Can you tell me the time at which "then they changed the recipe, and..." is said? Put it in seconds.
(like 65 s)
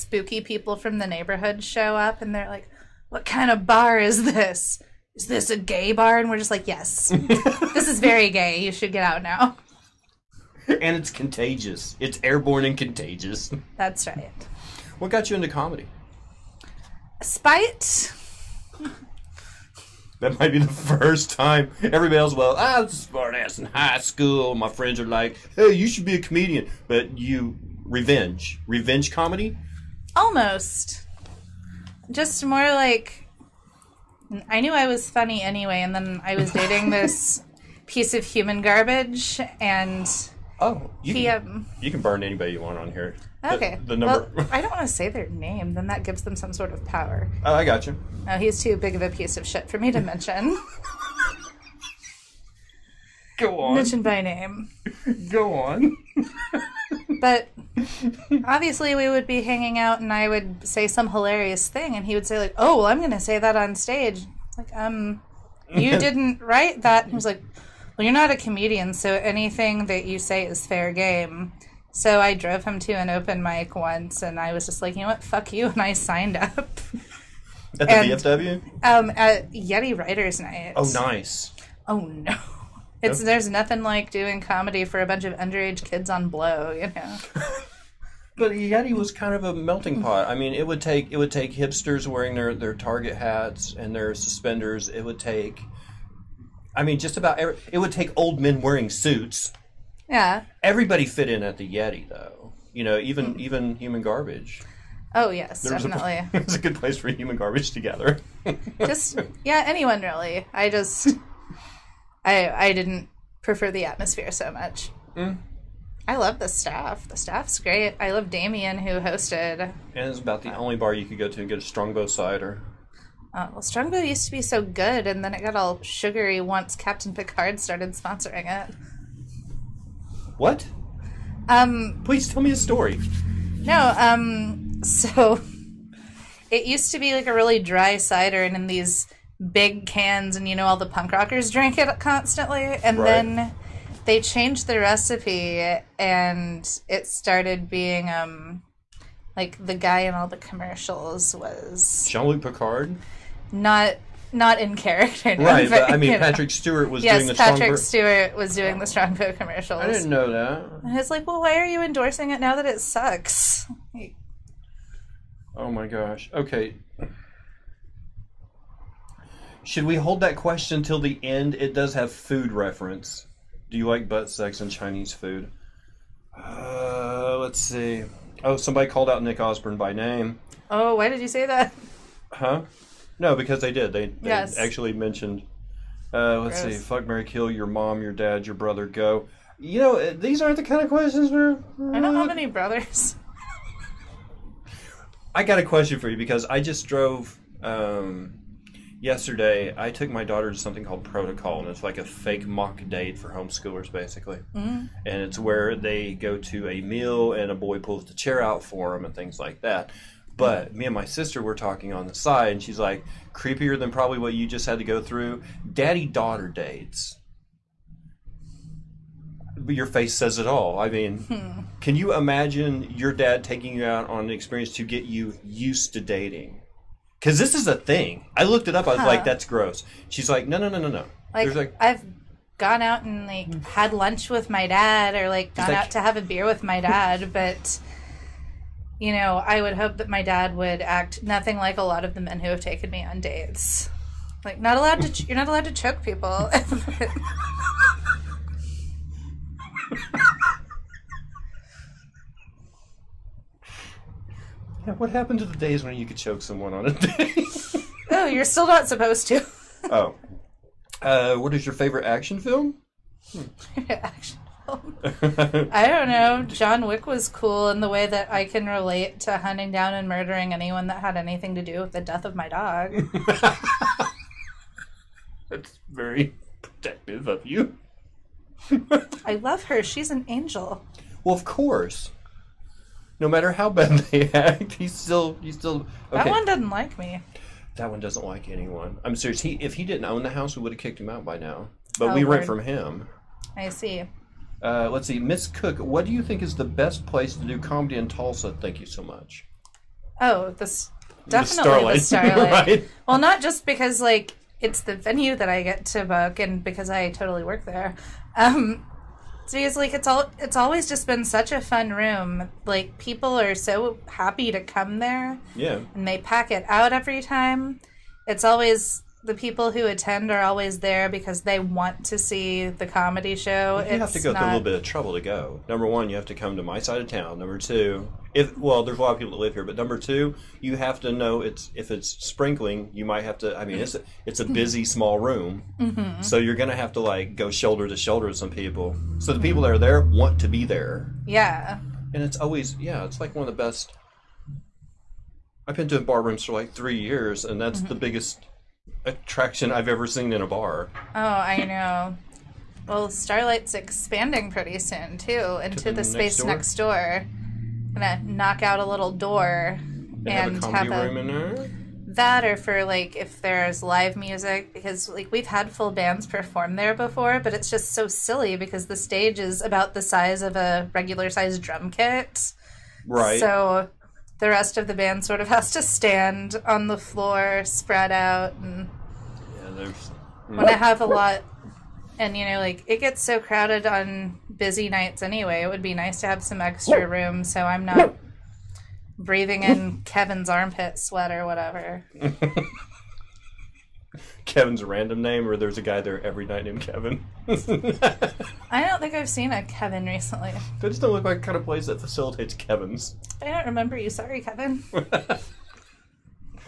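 143 s.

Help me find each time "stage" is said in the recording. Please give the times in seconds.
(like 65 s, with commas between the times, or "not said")
63 s, 368 s.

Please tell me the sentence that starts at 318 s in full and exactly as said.
It's always the people who attend are always there because they want to see the comedy show.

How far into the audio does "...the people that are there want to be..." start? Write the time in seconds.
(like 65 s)
339 s.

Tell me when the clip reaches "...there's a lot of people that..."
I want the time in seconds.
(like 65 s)
328 s.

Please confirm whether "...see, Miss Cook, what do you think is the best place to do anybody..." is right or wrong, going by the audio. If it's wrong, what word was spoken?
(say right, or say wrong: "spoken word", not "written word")
wrong: "comedy", not "anybody".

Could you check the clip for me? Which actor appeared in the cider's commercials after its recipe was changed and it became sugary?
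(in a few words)
Patrick Stewart.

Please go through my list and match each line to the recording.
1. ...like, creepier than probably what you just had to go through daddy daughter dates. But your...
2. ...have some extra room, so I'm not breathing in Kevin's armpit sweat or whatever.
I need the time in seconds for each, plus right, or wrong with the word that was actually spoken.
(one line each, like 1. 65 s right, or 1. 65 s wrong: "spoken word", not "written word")
1. 212 s right
2. 386 s right.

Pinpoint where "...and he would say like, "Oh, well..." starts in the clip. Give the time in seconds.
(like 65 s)
61 s.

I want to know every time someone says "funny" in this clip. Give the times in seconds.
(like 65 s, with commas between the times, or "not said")
35 s.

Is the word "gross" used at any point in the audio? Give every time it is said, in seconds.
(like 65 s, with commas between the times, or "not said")
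186 s, 229 s.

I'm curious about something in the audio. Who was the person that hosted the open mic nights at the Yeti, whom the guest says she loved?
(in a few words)
Damien.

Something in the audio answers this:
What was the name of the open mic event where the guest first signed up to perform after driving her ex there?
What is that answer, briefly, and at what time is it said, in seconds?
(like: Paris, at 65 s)
Yeti Writers Night, at 79 s.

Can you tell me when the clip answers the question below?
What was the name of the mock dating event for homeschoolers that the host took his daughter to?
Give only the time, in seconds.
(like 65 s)
201 s.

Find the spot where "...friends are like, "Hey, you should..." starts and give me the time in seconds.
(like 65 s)
24 s.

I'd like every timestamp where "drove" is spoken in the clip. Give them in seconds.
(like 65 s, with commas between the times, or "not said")
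72 s, 196 s.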